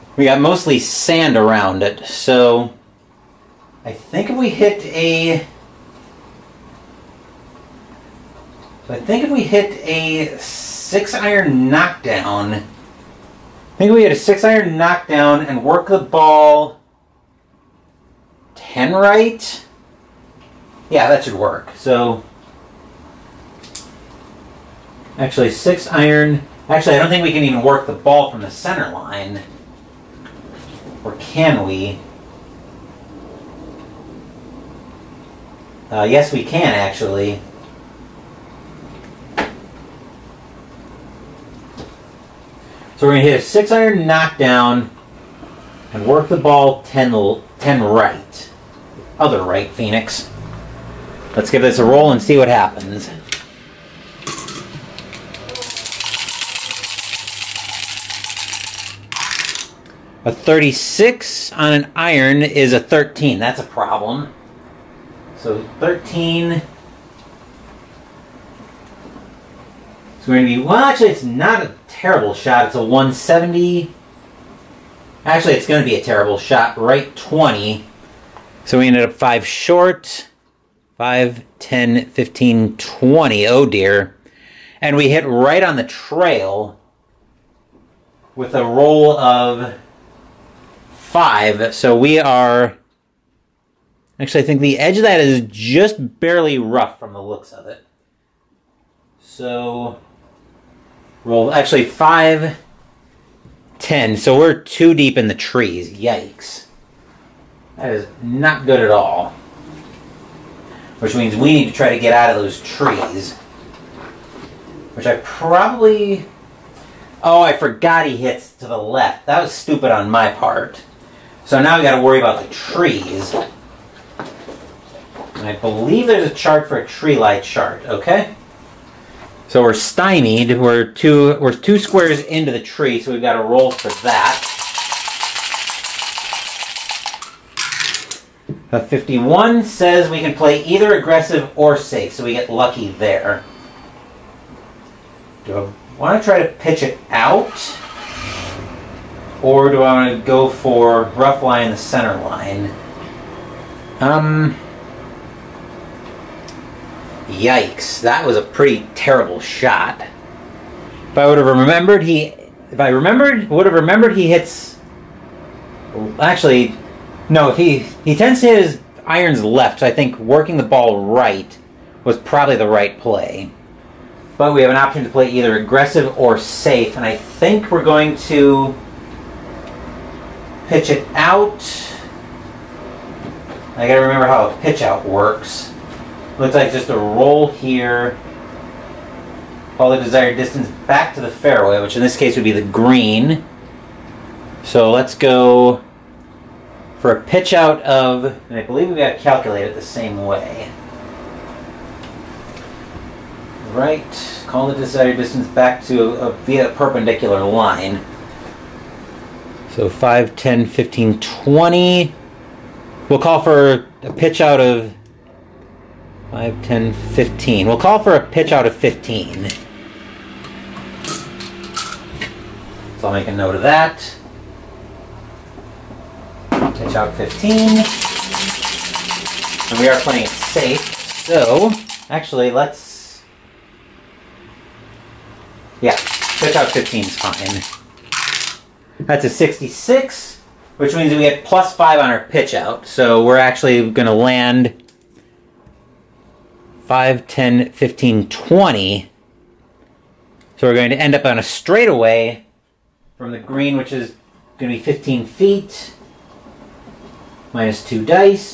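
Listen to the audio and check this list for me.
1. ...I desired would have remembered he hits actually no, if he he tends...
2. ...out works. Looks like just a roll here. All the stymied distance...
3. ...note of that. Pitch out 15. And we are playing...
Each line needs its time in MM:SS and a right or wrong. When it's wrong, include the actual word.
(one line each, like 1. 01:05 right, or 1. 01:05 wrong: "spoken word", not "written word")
1. 02:42 wrong: "remembered", not "desired"
2. 03:04 wrong: "desired", not "stymied"
3. 03:43 right.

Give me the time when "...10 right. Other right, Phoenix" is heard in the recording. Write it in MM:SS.
00:47.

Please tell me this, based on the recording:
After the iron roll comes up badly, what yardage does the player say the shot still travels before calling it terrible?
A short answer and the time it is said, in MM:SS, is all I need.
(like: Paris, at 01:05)
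170, at 01:12.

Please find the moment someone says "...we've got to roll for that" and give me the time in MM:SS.
02:13.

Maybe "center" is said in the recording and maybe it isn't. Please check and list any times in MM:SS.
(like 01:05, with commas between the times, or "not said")
00:28, 02:31.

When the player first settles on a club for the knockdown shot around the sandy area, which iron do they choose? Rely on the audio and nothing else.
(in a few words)
6 iron.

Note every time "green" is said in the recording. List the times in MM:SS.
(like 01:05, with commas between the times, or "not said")
03:12, 04:13.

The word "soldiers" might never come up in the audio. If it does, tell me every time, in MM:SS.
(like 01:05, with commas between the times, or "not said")
not said.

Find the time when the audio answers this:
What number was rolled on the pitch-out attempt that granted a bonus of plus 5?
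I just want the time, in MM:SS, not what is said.
03:59.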